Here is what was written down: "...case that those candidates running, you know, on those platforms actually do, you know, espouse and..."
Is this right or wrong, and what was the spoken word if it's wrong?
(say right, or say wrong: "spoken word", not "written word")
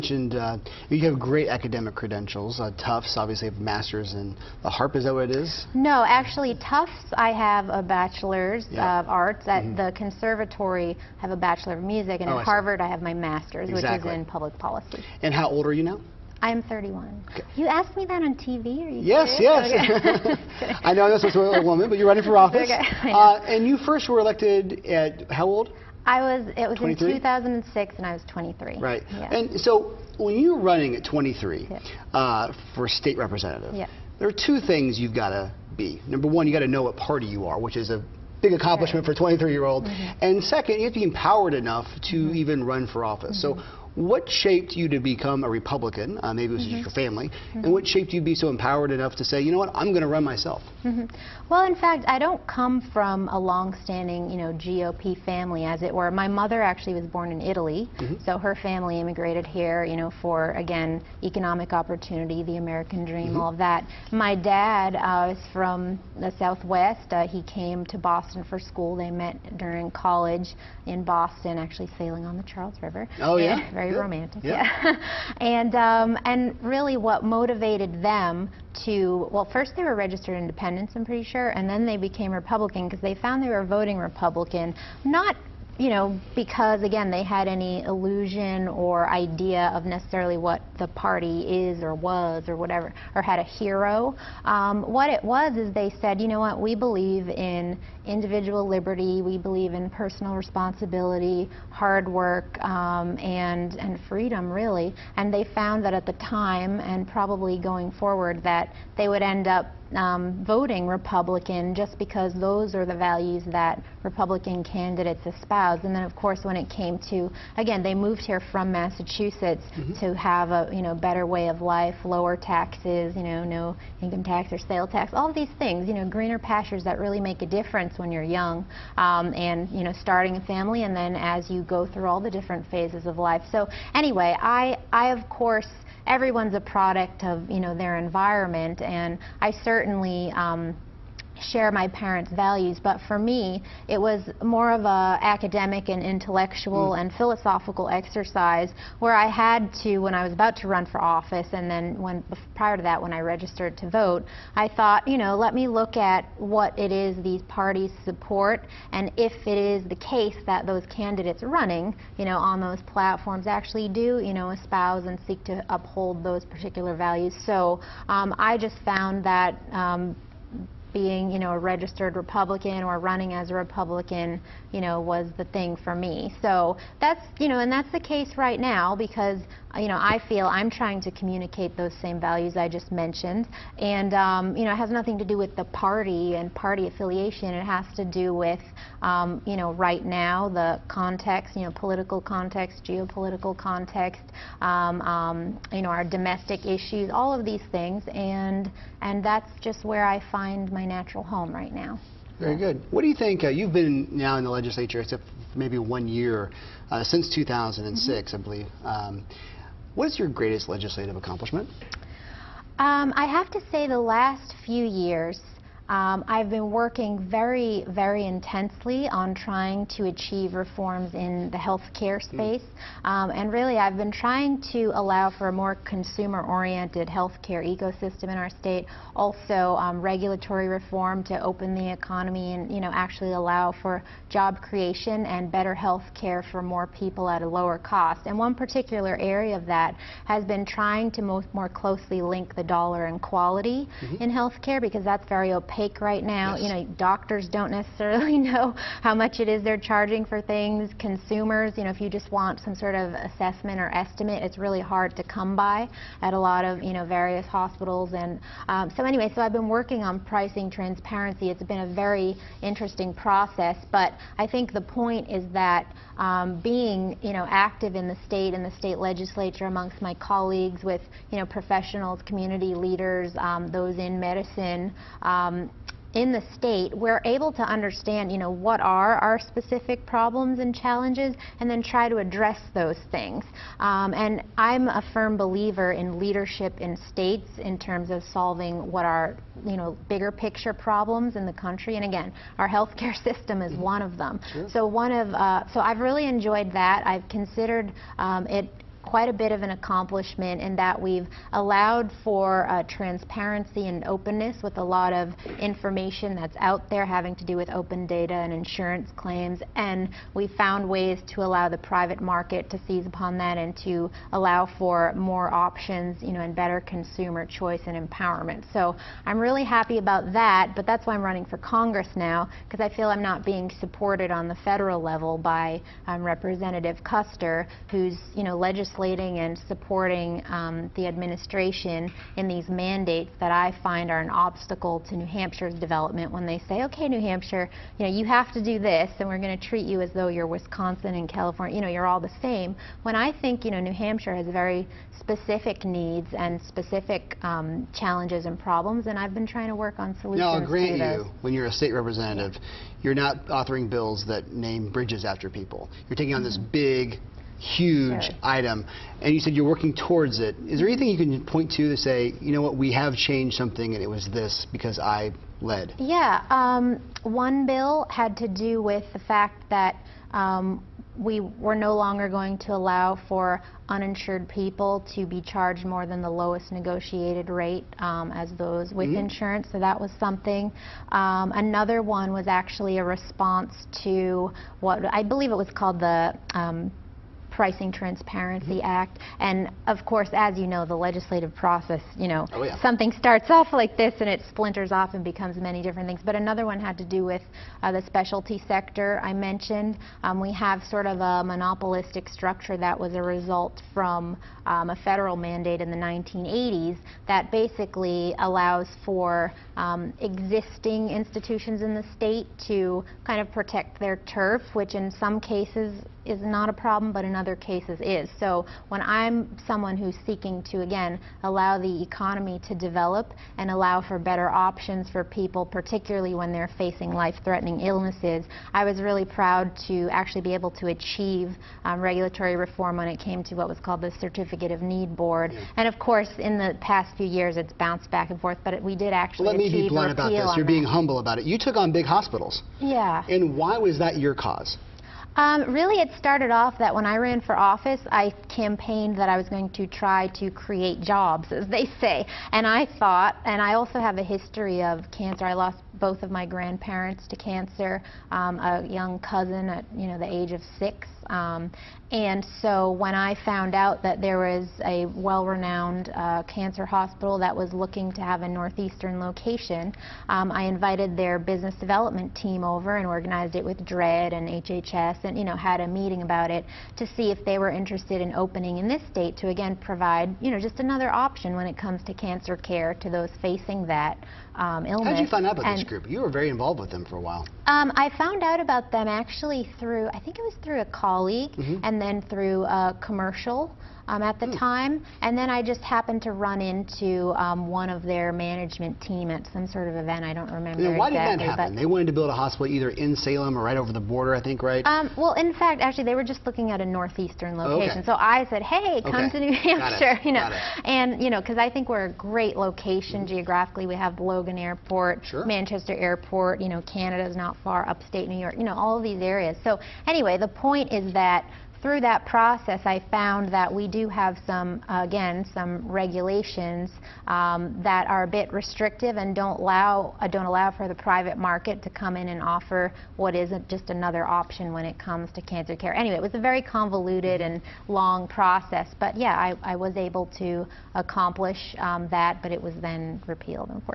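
right.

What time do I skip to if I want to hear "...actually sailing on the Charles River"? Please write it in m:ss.
1:11.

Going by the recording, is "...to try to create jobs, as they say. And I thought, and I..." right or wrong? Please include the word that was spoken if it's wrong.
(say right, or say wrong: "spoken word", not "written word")
right.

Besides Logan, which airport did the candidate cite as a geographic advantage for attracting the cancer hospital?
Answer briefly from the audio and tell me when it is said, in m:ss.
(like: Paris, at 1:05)
Manchester Airport, at 8:35.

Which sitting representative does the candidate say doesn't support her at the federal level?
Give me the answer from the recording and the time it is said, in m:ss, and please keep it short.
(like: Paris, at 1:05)
Kuster, at 5:27.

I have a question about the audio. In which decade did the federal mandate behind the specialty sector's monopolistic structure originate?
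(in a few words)
1980s.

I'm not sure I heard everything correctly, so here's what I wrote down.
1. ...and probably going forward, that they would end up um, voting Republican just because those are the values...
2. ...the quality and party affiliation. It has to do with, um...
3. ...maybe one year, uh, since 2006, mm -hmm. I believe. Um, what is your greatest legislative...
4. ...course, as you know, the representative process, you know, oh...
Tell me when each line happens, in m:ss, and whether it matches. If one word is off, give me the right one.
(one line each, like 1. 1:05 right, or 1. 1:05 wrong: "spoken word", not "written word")
1. 1:46 right
2. 3:05 wrong: "party", not "quality"
3. 3:25 right
4. 6:30 wrong: "legislative", not "representative".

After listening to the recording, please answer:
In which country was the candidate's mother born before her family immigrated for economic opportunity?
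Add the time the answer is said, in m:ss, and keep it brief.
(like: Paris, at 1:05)
Italy, at 0:57.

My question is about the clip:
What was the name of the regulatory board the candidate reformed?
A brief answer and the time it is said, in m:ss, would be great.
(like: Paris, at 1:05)
Certificate of Need board, at 7:14.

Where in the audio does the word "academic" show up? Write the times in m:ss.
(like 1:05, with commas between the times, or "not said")
0:01, 2:25.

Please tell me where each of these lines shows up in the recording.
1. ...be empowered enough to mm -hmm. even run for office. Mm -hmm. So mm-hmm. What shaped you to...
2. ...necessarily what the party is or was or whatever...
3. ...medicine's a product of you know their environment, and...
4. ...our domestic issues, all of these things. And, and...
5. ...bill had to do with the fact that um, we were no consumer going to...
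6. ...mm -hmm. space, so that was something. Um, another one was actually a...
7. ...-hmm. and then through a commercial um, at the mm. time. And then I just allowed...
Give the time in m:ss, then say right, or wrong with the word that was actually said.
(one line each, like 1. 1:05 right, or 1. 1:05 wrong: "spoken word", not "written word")
1. 0:41 right
2. 1:29 right
3. 2:16 wrong: "everyone", not "medicine"
4. 3:15 right
5. 6:07 wrong: "longer", not "consumer"
6. 6:19 wrong: "insurance", not "space"
7. 8:11 wrong: "happened", not "allowed".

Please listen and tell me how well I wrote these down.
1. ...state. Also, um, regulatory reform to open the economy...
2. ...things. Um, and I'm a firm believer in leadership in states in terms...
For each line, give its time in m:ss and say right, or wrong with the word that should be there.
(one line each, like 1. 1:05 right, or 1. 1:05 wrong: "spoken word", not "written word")
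1. 3:48 right
2. 4:43 right.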